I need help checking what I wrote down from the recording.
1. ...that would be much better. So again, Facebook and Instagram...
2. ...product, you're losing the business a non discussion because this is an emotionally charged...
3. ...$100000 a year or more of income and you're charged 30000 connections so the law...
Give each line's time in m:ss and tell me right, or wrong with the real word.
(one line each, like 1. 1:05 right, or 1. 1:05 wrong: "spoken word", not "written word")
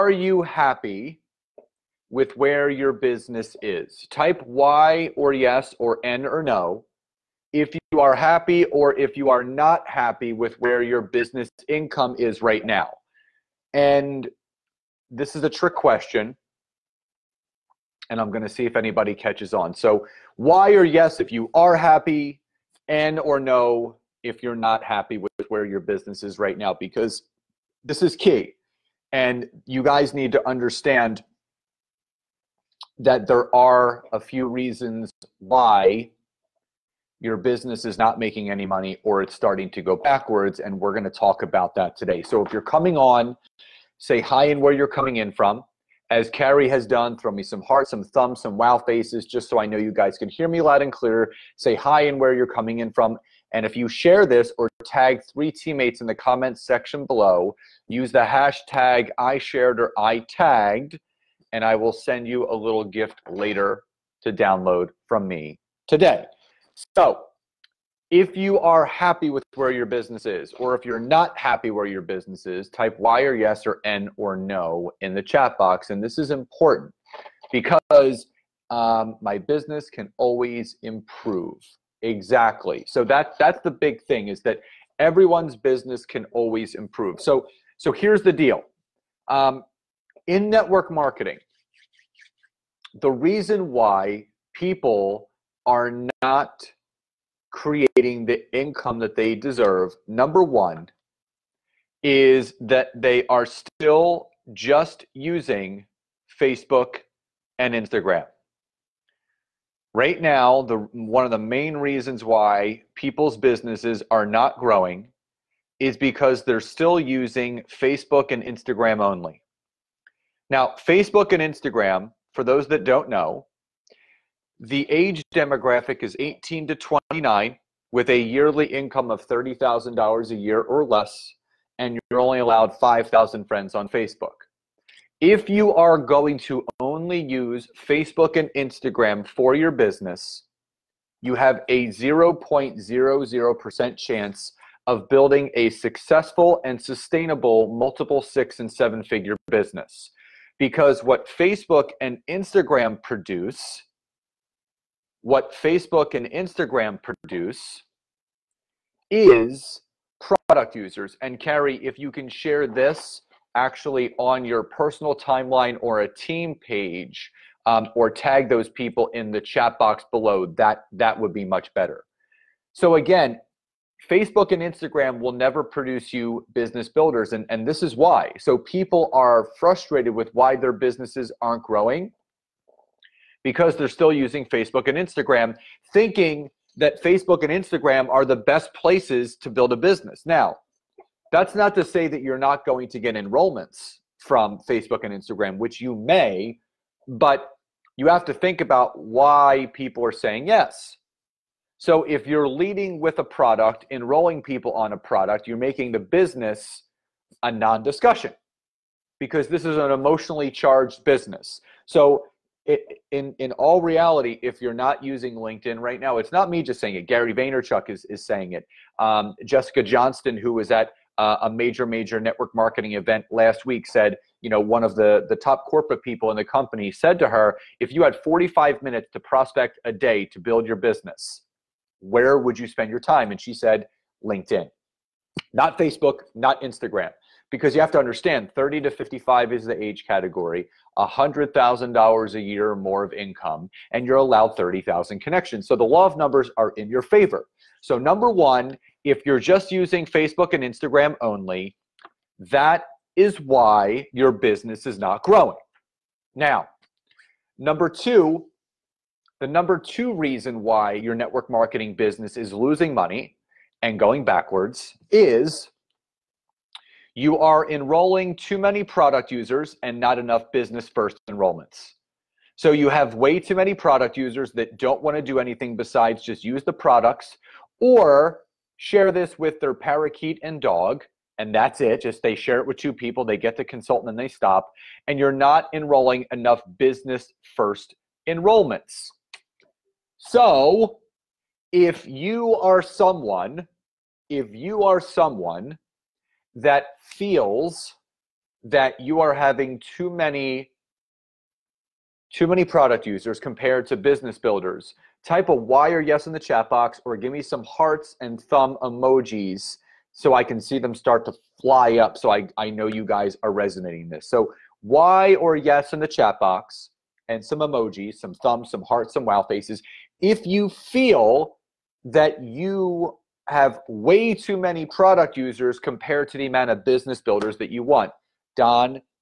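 1. 2:50 right
2. 3:24 wrong: "making", not "losing"
3. 4:00 wrong: "allowed", not "charged".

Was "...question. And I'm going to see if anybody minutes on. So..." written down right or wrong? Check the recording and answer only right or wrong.
wrong.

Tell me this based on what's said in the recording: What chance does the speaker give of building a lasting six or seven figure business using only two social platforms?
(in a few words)
0.00%.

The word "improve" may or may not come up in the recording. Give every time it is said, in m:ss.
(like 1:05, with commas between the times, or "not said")
1:20, 1:26.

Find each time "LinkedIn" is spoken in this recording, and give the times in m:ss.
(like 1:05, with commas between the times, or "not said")
3:35, 3:54.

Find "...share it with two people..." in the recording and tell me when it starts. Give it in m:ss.
4:42.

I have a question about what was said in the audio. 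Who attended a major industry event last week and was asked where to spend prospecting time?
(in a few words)
Jessica Johnston.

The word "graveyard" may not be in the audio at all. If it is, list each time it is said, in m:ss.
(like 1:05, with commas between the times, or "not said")
not said.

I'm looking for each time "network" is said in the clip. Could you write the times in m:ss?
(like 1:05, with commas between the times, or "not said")
1:30, 3:42, 4:21.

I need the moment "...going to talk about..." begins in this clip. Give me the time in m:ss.
0:40.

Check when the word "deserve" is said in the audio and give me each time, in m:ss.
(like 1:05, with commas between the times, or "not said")
1:39.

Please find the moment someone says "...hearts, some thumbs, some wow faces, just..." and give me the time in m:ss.
0:47.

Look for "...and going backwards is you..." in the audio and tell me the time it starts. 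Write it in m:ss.
4:23.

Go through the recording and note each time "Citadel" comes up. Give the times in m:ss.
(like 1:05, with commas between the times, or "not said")
not said.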